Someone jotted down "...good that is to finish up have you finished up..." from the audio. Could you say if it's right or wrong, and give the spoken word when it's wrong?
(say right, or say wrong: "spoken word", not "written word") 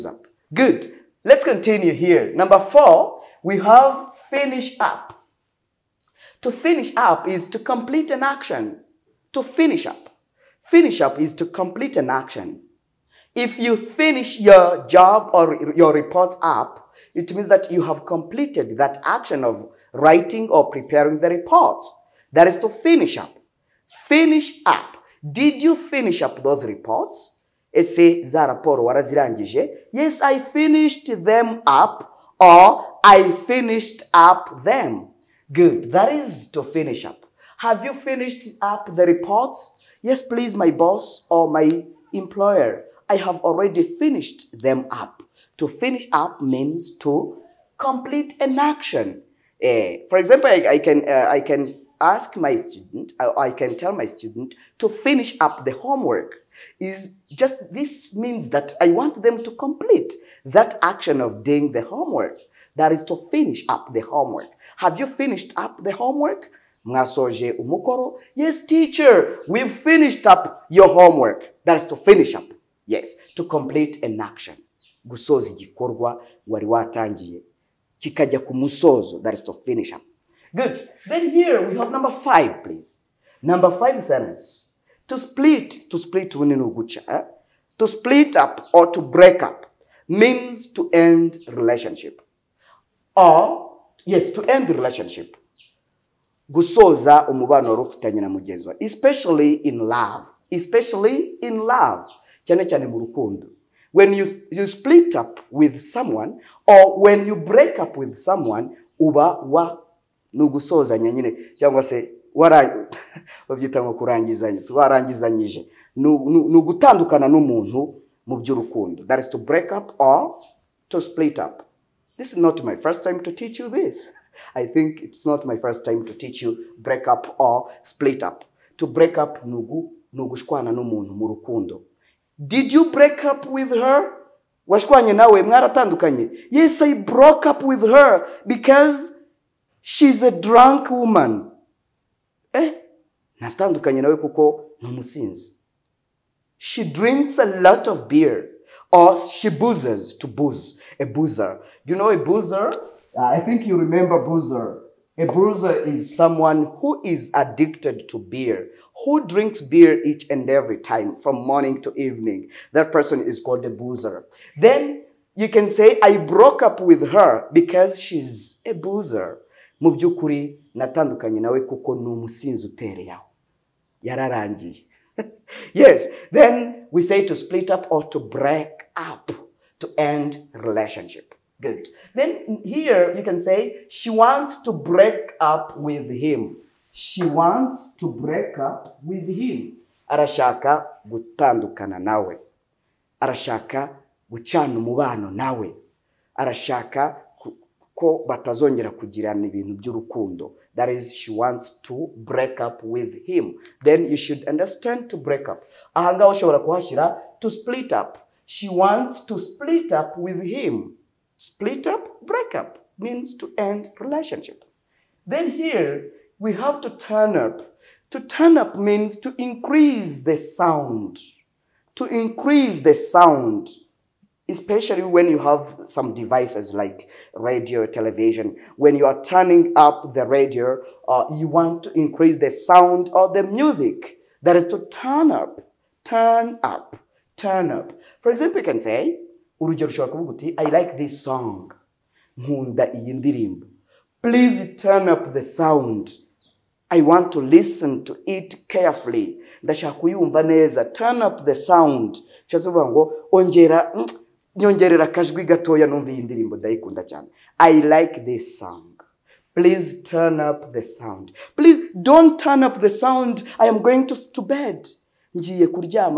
right.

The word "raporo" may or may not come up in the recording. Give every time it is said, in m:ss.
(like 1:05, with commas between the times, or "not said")
0:28.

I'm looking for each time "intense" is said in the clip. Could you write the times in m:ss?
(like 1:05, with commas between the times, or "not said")
not said.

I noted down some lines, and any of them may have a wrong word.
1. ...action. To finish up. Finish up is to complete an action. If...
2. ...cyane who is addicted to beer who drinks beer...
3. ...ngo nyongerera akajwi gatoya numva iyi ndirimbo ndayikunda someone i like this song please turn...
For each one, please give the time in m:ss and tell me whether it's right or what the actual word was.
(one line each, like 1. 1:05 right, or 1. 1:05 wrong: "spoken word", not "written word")
1. 0:08 right
2. 2:36 wrong: "someone", not "cyane"
3. 4:12 wrong: "cyane", not "someone".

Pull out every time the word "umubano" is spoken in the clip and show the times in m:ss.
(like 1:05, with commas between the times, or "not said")
1:37, 3:14.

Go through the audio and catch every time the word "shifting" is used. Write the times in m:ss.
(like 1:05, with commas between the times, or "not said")
not said.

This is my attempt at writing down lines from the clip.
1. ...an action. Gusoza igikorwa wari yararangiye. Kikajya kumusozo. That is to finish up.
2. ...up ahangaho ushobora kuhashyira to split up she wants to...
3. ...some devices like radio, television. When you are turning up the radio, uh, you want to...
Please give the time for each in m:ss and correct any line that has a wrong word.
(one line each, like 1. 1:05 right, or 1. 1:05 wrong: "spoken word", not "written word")
1. 1:14 wrong: "watangiye", not "yararangiye"
2. 3:25 right
3. 3:45 right.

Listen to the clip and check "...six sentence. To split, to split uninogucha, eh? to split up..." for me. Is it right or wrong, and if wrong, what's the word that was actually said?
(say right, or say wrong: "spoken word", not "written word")
wrong: "five", not "six".